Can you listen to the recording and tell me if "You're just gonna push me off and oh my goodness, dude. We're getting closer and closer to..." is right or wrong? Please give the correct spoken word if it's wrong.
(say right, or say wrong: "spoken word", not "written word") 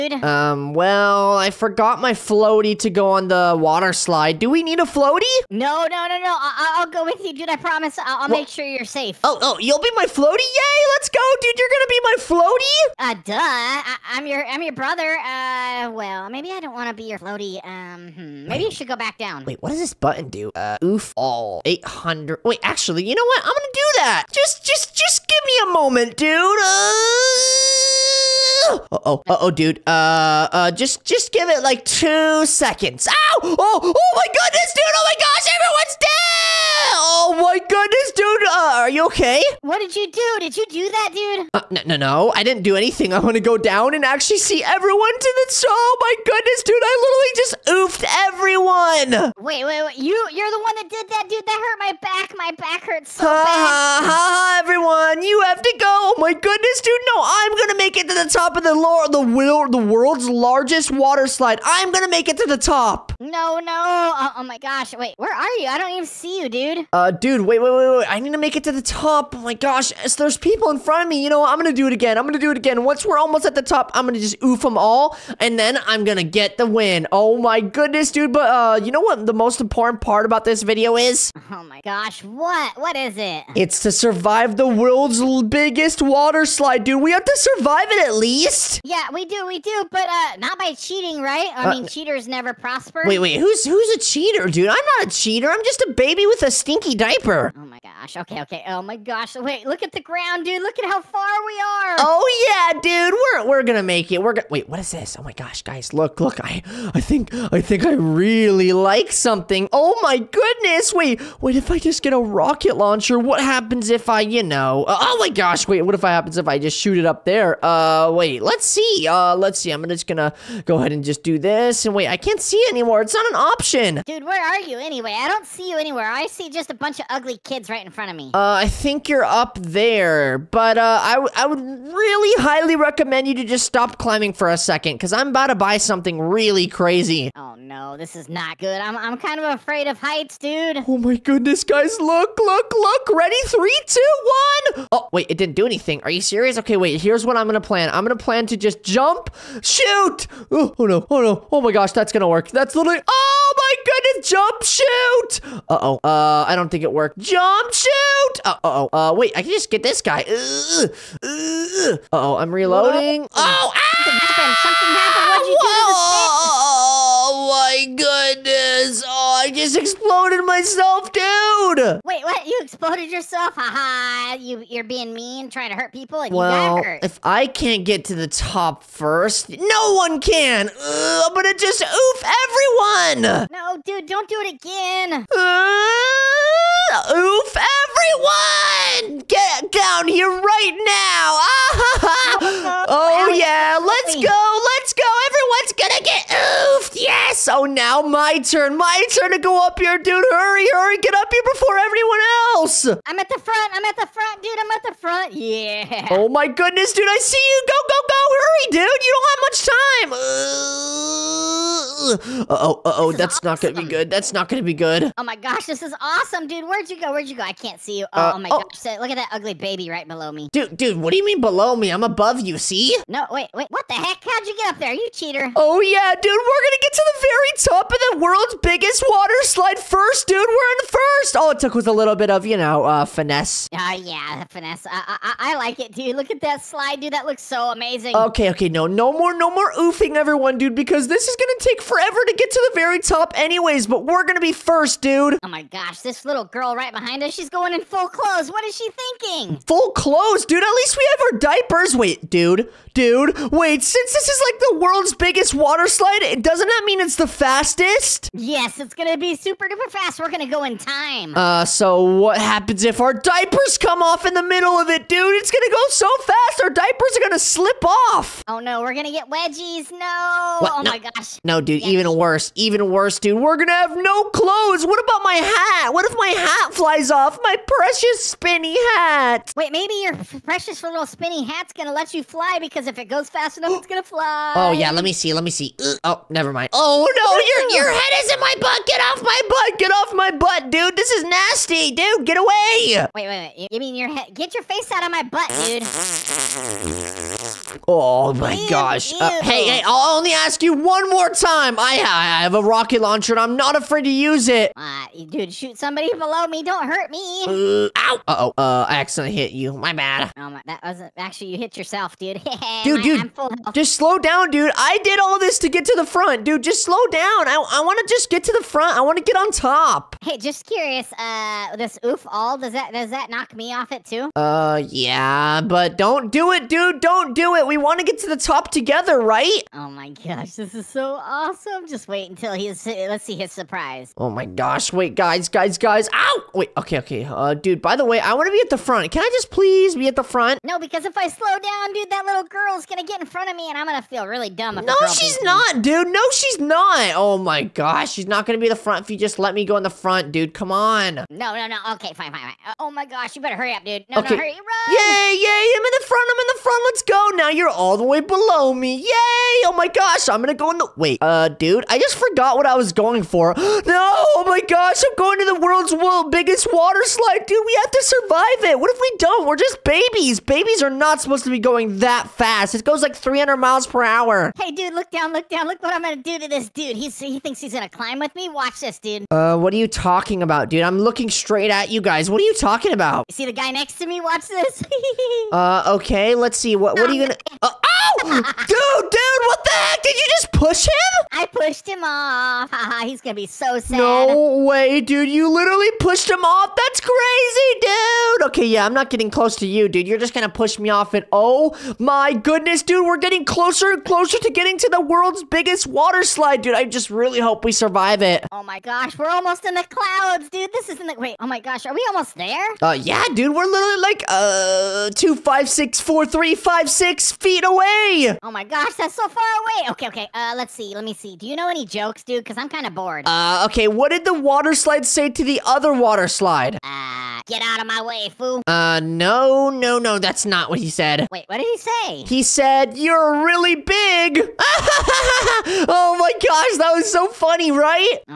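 right.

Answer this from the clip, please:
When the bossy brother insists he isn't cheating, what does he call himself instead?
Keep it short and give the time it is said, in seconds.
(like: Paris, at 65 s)
a baby with a stinky diaper, at 95 s.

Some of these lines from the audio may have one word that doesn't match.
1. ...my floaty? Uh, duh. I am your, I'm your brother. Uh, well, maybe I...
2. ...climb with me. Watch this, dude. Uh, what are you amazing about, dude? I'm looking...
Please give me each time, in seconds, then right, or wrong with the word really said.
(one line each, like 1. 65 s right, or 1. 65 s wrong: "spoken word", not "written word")
1. 12 s right
2. 377 s wrong: "talking", not "amazing".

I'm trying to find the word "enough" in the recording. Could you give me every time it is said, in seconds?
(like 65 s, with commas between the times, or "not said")
283 s.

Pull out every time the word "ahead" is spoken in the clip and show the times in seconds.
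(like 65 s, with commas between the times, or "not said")
120 s.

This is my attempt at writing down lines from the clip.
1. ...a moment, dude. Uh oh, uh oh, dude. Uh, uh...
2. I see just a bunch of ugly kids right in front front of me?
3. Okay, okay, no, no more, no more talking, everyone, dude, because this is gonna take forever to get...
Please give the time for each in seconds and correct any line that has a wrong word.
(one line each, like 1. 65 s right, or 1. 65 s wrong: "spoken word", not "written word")
1. 25 s right
2. 126 s right
3. 238 s wrong: "oofing", not "talking".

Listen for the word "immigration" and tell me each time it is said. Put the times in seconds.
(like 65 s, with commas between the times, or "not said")
not said.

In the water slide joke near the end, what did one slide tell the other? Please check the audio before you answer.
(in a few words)
you're really big.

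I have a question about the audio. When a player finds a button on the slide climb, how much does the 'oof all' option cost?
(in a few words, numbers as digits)
800.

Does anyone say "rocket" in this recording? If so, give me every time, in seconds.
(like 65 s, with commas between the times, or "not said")
112 s, 302 s.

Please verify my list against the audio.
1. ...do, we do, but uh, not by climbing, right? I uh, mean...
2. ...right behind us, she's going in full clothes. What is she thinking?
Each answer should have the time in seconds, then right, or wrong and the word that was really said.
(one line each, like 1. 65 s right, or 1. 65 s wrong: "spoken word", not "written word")
1. 89 s wrong: "cheating", not "climbing"
2. 246 s right.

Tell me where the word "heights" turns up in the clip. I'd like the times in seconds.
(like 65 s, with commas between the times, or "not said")
139 s.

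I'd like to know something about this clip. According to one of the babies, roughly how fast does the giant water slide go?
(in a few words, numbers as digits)
300 miles per hour.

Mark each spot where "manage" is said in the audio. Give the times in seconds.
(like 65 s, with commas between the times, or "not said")
not said.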